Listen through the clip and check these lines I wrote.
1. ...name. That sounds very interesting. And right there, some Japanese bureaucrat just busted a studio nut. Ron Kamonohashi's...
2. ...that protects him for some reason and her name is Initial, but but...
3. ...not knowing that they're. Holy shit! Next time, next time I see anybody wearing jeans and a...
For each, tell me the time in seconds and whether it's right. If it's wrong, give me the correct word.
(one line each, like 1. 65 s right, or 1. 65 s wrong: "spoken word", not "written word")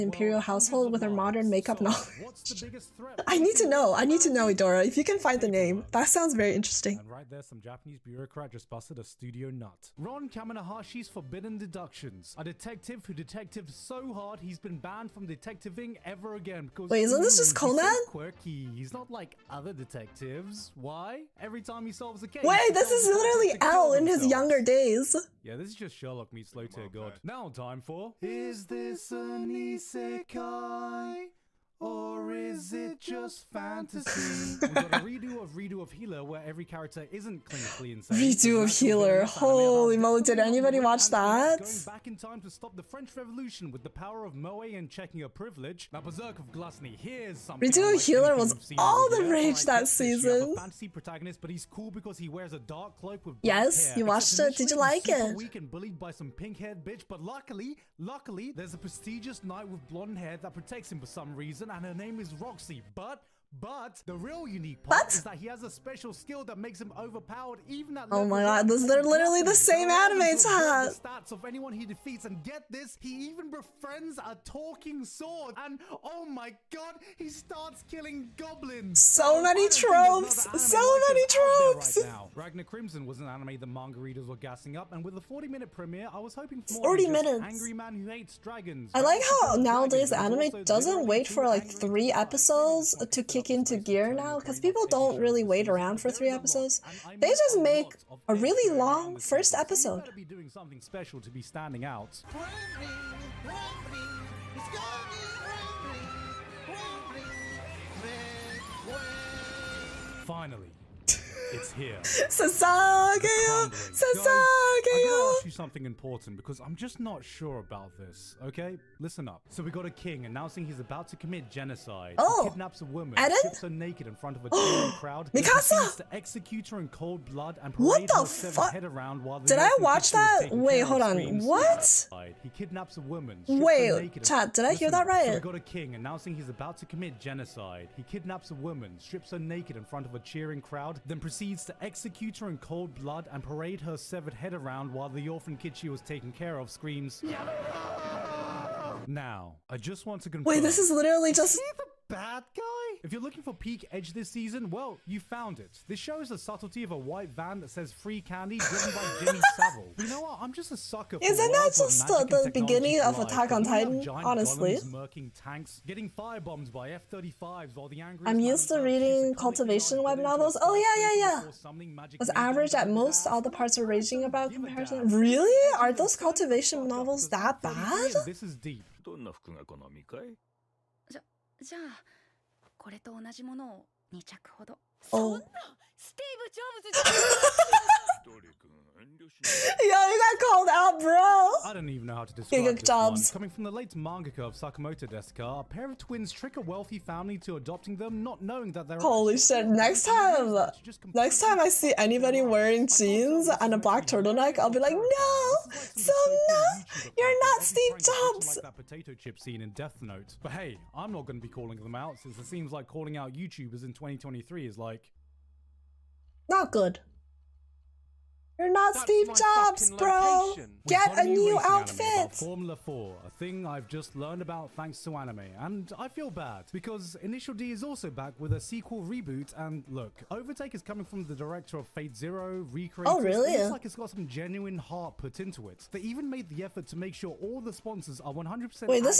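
1. 5 s right
2. 60 s wrong: "Roxy", not "Initial"
3. 198 s right.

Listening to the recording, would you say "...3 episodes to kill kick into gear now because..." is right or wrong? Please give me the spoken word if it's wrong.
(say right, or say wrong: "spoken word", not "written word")
right.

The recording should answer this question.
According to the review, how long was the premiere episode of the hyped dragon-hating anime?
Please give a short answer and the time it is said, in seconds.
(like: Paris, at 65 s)
40 minutes, at 85 s.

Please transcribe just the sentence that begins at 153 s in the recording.
If you're looking for peak edge this season, well, you found it.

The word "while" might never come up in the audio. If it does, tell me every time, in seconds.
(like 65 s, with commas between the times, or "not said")
129 s, 144 s.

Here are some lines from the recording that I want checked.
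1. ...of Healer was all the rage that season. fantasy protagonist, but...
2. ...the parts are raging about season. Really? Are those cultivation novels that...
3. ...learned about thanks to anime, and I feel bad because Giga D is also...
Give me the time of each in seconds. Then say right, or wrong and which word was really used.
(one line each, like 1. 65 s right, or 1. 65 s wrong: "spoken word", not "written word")
1. 47 s right
2. 173 s wrong: "comparison", not "season"
3. 224 s wrong: "Initial", not "Giga".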